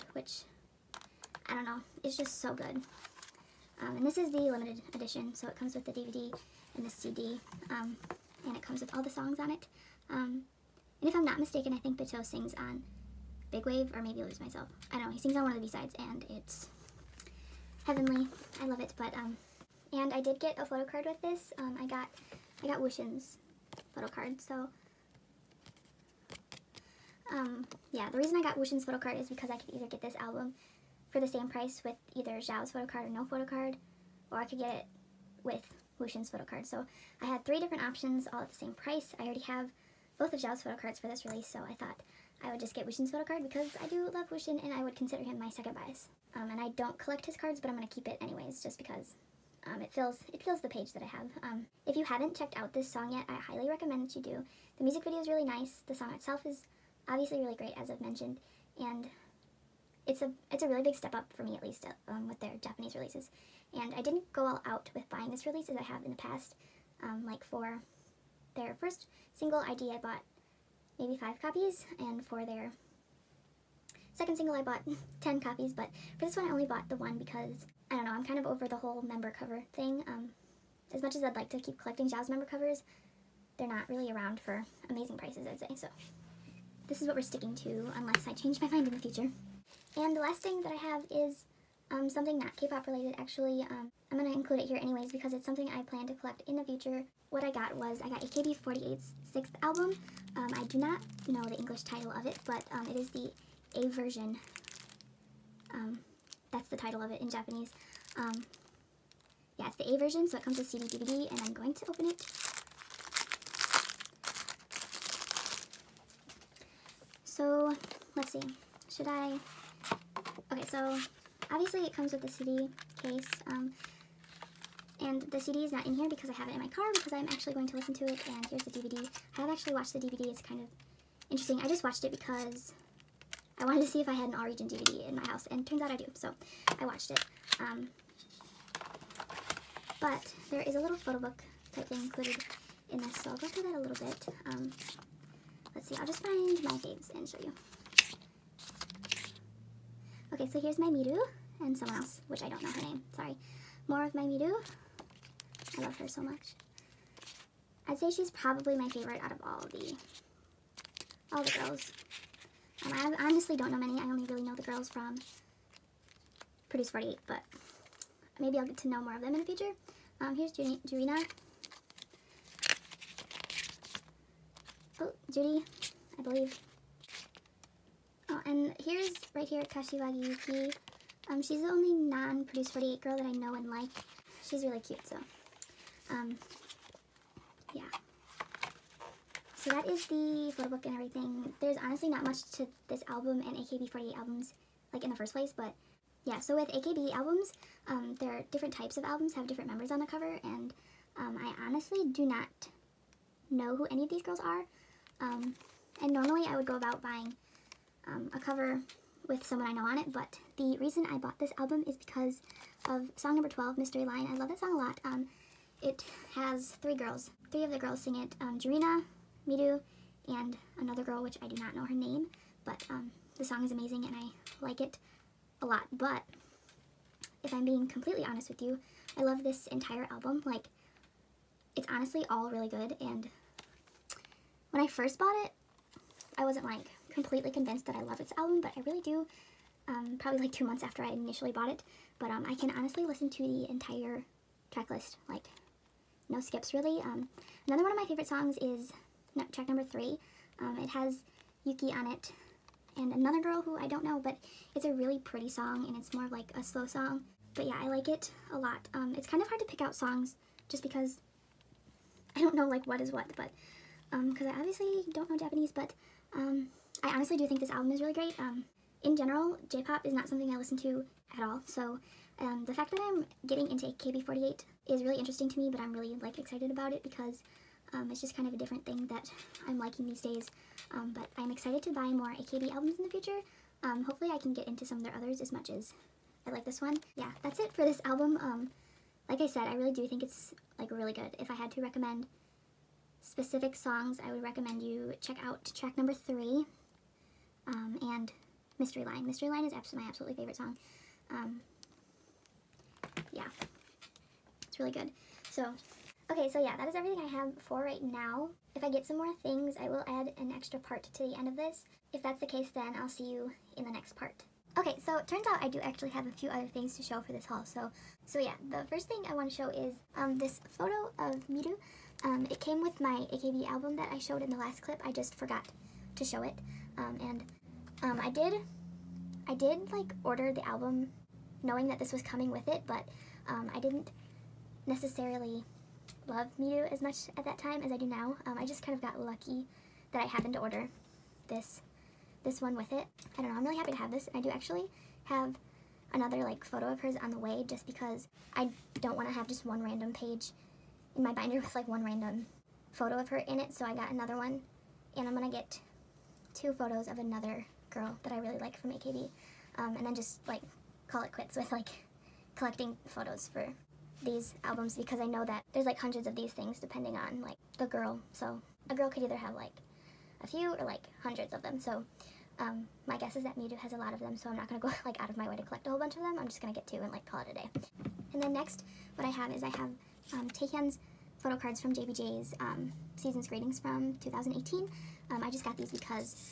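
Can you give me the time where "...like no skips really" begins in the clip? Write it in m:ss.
4:05.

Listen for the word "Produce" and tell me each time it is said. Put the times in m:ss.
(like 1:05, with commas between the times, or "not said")
2:46, 3:01.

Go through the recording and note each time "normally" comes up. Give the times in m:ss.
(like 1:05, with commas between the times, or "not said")
3:26.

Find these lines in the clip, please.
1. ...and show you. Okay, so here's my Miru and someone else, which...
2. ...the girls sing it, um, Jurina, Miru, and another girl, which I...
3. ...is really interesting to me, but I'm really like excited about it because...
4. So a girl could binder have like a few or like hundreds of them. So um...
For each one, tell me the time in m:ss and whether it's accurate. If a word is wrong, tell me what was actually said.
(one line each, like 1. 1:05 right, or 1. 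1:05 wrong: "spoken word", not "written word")
1. 2:27 right
2. 3:37 right
3. 4:34 right
4. 6:08 wrong: "either", not "binder".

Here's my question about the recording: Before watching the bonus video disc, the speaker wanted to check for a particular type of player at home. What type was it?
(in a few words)
All Region DVD.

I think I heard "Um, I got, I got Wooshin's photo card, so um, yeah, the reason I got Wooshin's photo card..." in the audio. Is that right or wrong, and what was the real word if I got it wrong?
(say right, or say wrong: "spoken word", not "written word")
right.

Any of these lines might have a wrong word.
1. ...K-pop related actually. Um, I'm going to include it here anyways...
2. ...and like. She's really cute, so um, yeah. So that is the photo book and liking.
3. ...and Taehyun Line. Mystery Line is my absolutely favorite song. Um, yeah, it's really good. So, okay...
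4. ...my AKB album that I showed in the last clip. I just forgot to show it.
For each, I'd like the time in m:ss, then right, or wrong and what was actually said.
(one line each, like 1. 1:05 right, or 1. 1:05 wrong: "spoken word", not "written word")
1. 1:32 right
2. 3:03 wrong: "everything", not "liking"
3. 4:58 wrong: "Mystery", not "Taehyun"
4. 5:23 right.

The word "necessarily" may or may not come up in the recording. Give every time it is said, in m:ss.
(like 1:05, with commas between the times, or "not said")
5:34.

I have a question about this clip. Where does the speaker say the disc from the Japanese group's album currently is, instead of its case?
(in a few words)
In my car.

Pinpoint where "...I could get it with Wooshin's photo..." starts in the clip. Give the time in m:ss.
0:34.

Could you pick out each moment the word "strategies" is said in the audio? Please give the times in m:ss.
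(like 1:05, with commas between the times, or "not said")
not said.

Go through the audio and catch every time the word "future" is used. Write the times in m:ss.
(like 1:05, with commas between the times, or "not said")
1:28, 1:36, 2:49, 4:43.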